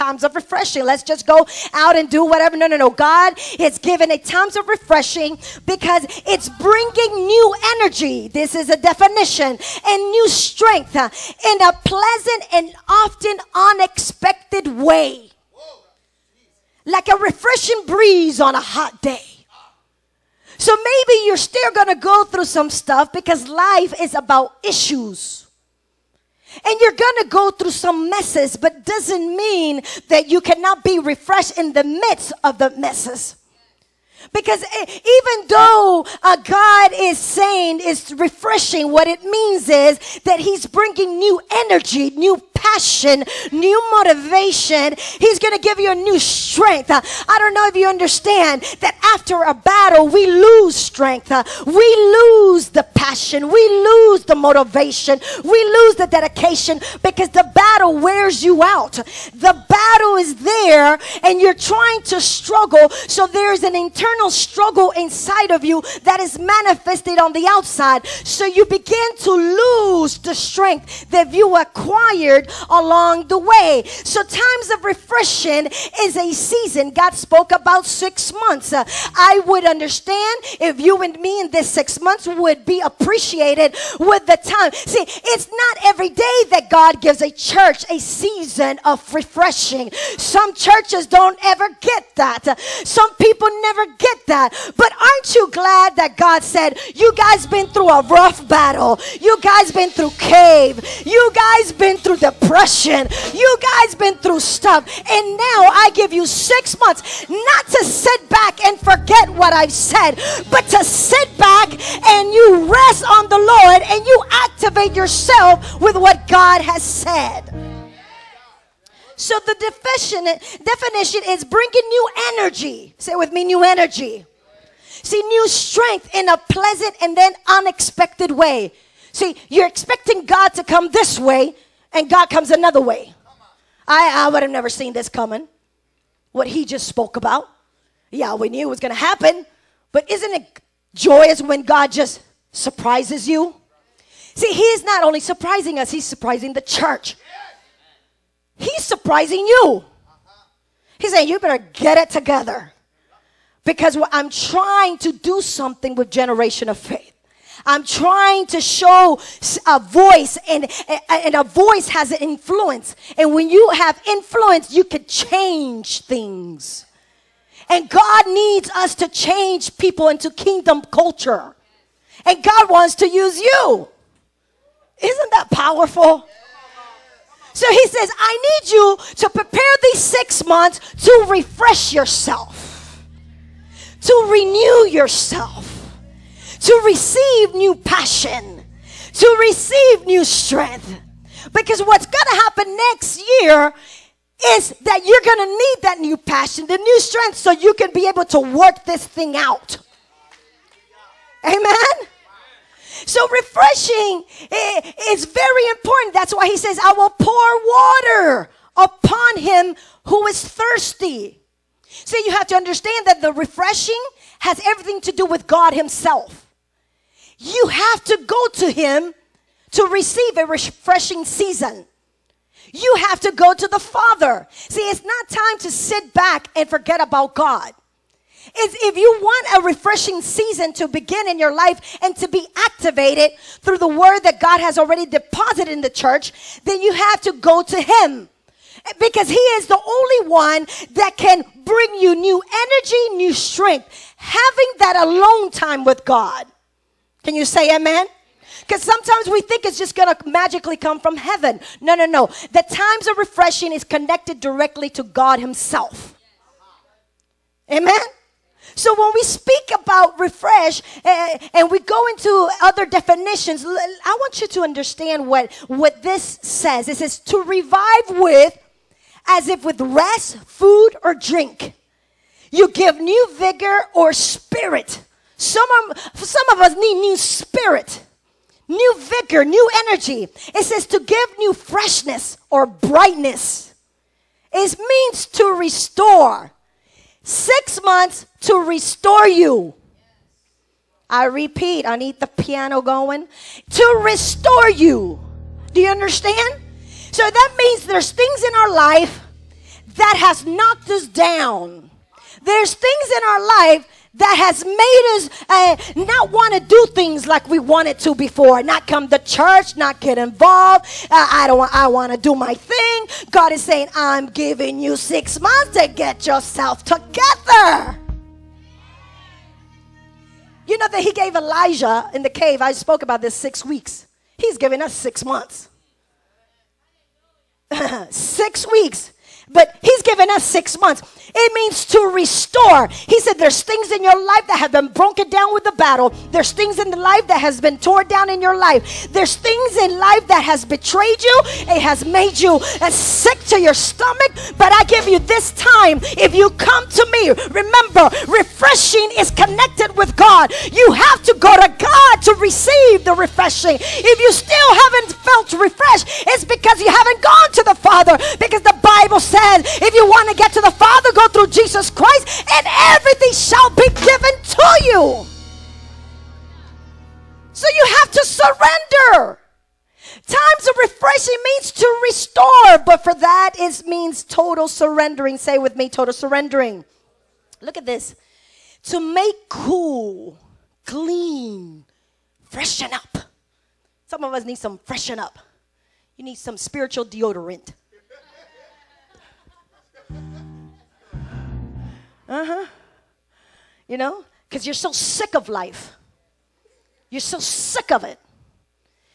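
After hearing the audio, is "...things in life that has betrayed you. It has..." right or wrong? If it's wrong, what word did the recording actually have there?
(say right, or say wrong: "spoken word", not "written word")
right.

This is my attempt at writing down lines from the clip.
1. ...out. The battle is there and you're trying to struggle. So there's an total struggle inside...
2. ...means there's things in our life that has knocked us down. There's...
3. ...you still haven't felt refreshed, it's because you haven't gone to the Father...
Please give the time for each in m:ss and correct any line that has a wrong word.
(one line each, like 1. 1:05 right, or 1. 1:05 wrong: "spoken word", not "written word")
1. 0:58 wrong: "internal", not "total"
2. 4:57 right
3. 5:54 right.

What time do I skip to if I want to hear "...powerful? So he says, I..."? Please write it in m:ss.
2:55.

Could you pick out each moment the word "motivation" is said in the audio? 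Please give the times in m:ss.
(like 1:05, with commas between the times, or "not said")
0:43, 0:54.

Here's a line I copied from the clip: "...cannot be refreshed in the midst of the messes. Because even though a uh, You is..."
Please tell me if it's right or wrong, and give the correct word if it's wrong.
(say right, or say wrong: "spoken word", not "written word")
wrong: "God", not "You".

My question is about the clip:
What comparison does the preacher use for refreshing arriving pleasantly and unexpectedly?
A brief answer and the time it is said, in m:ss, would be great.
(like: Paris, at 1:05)
A refreshing breeze on a hot day, at 0:16.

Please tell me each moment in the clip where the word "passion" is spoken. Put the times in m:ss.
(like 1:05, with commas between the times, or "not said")
0:42, 0:52, 3:07, 3:16.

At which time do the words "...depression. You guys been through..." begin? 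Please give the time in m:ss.
1:42.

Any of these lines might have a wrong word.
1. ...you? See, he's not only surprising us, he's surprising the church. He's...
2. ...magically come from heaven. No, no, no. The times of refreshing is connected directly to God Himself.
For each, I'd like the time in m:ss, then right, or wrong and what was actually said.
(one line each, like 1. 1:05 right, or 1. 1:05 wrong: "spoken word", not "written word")
1. 2:23 right
2. 4:10 right.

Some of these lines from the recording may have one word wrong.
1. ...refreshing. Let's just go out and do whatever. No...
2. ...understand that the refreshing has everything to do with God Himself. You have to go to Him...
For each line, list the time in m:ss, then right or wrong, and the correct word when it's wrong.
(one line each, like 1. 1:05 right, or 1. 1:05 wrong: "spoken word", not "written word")
1. 0:00 right
2. 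3:32 right.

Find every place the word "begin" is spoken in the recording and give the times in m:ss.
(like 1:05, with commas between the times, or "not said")
1:08, 3:50.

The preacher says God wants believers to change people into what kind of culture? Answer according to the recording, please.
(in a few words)
Kingdom culture.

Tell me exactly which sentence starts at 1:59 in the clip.
So the definition, definition is bringing new energy.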